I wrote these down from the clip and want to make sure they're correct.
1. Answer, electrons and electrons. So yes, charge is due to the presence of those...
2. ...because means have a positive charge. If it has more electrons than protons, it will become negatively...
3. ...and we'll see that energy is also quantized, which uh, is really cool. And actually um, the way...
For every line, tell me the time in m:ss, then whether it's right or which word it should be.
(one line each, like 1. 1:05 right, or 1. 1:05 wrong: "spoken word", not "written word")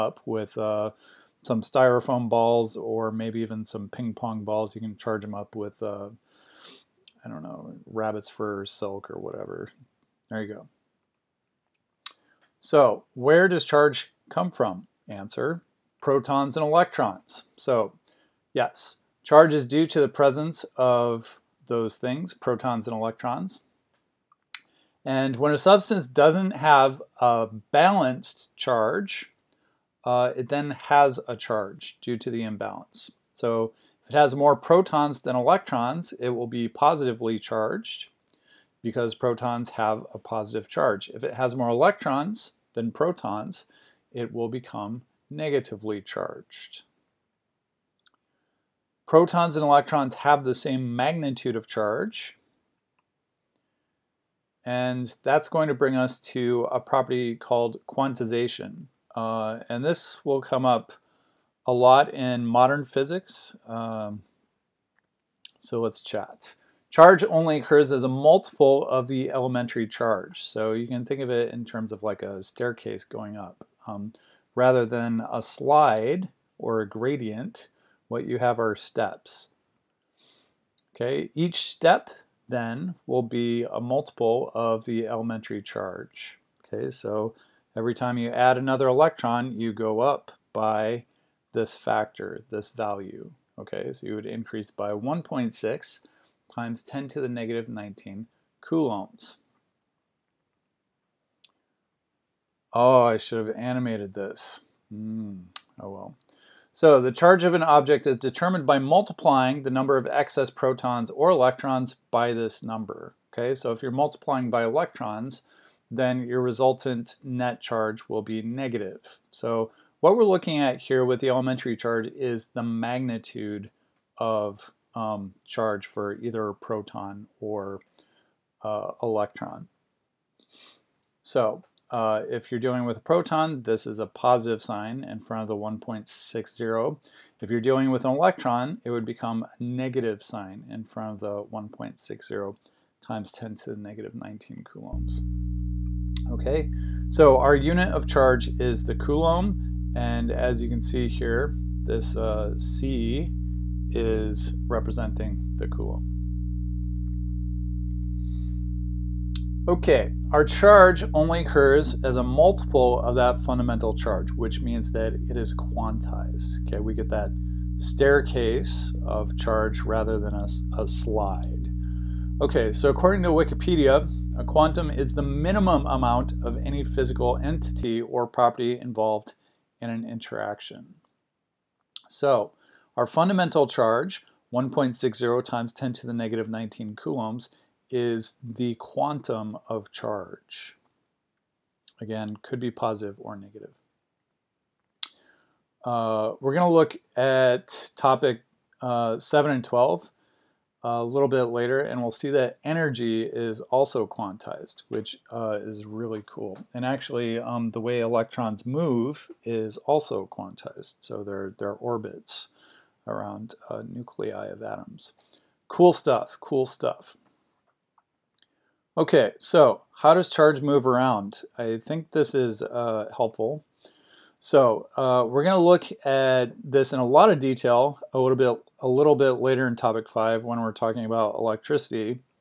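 1. 0:15 wrong: "protons", not "electrons"
2. 0:38 wrong: "protons", not "means"
3. 3:21 right.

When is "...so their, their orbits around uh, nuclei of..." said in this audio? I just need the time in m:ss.
3:31.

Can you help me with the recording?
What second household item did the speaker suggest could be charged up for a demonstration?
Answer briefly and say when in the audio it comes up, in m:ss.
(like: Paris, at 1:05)
ping pong balls, at 0:03.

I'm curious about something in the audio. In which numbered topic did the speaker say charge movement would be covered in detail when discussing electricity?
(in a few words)
topic 5.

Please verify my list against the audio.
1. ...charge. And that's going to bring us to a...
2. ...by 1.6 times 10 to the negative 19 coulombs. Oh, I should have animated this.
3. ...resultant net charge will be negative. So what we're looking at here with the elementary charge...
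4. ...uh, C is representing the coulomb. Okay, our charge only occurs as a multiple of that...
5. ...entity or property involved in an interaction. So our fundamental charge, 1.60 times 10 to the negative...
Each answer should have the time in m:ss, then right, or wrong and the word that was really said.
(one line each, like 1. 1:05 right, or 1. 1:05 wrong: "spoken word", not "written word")
1. 0:51 right
2. 1:34 right
3. 1:56 right
4. 2:32 right
5. 2:57 right.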